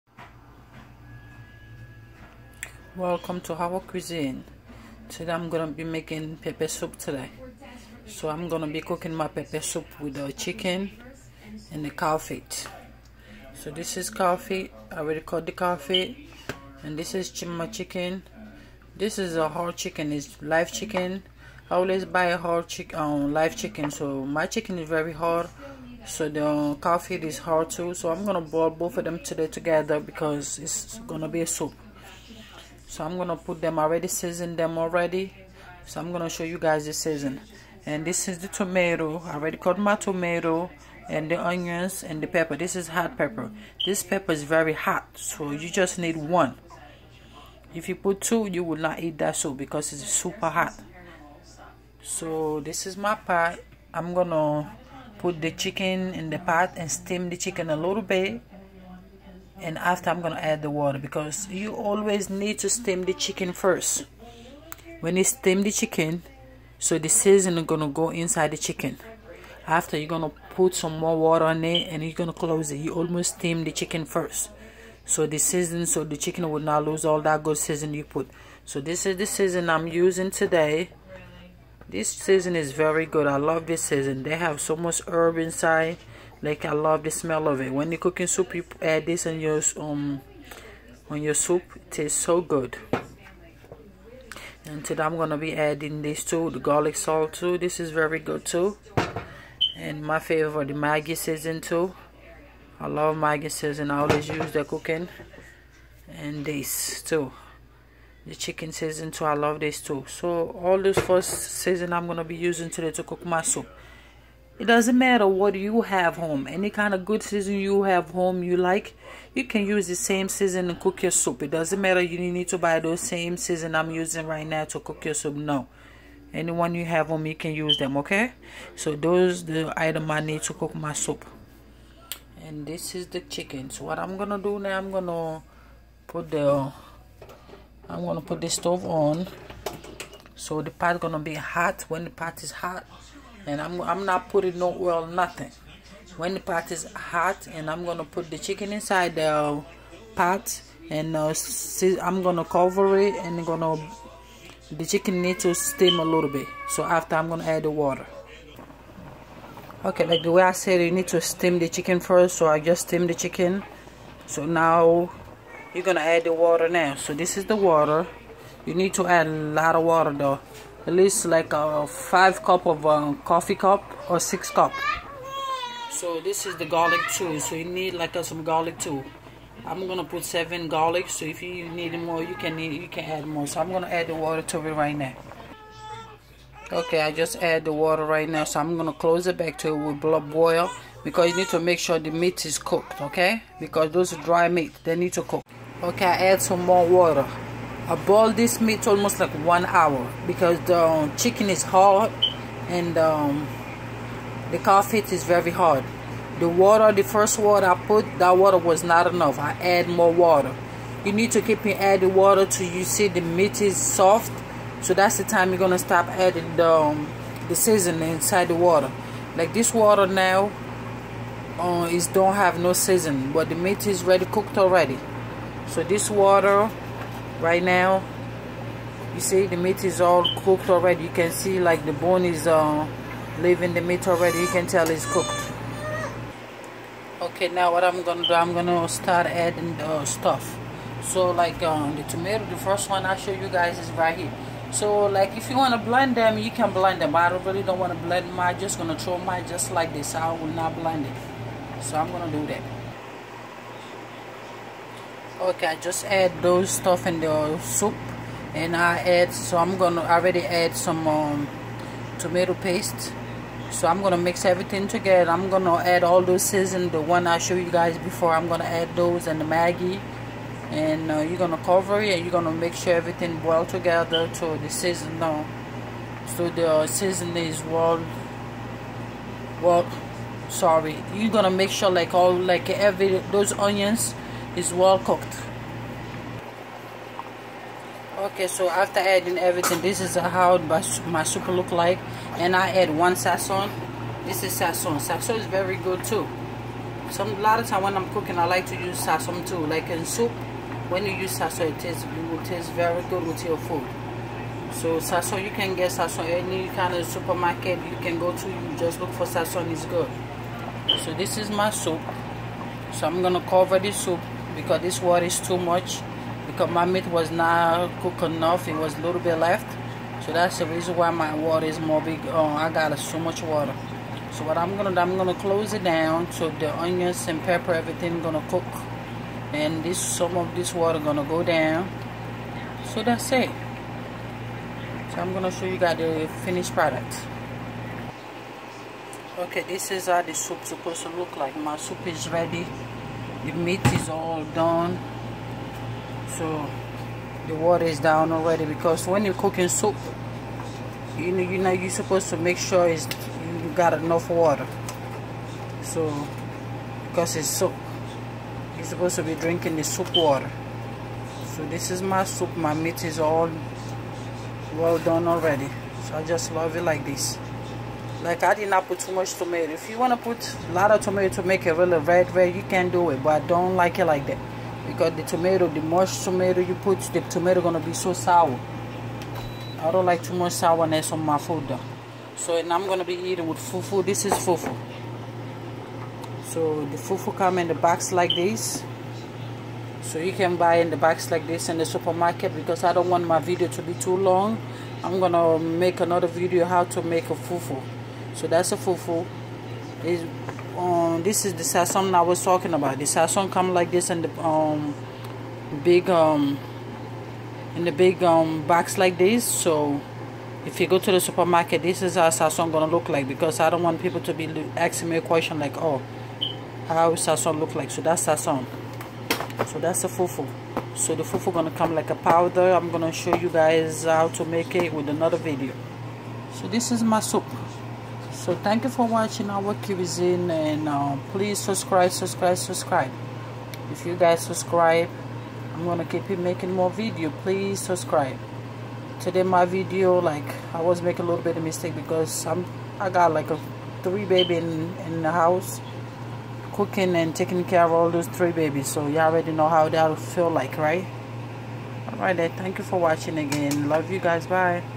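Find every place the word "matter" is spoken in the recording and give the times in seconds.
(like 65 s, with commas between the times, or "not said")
114 s, 121 s.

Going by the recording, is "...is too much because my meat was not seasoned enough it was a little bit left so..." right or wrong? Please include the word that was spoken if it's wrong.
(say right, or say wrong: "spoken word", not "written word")
wrong: "cooked", not "seasoned".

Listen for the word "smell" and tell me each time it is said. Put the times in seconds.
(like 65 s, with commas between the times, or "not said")
87 s.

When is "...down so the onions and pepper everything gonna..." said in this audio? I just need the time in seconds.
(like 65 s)
325 s.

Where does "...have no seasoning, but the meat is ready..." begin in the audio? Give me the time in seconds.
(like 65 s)
222 s.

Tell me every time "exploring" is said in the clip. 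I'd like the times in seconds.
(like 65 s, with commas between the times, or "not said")
not said.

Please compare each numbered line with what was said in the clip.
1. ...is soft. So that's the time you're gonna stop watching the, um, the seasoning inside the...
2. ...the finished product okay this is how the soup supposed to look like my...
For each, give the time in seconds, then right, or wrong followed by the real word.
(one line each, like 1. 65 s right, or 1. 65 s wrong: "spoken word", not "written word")
1. 213 s wrong: "adding", not "watching"
2. 335 s right.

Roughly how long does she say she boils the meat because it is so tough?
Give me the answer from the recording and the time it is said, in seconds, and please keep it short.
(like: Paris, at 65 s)
1 hour, at 199 s.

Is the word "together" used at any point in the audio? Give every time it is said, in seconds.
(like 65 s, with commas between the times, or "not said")
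29 s, 264 s, 273 s.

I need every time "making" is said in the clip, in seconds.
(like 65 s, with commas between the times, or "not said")
5 s, 436 s, 441 s.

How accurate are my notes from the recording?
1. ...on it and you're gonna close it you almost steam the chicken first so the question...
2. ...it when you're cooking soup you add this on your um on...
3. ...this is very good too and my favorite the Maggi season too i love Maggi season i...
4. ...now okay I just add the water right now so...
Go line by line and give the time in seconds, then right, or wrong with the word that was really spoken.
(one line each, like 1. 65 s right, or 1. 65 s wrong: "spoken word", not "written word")
1. 71 s wrong: "season", not "question"
2. 87 s right
3. 97 s right
4. 184 s right.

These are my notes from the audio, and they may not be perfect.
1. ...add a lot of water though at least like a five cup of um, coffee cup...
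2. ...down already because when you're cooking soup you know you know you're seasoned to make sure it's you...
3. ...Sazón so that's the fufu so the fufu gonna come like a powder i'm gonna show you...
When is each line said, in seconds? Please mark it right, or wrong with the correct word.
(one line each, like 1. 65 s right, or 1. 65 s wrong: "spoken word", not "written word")
1. 169 s right
2. 347 s wrong: "supposed", not "seasoned"
3. 418 s right.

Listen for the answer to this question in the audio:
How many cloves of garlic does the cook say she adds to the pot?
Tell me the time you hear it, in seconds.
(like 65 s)
180 s.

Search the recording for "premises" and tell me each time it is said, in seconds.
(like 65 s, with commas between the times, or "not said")
not said.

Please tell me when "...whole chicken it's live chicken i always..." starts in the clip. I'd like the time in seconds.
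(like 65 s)
19 s.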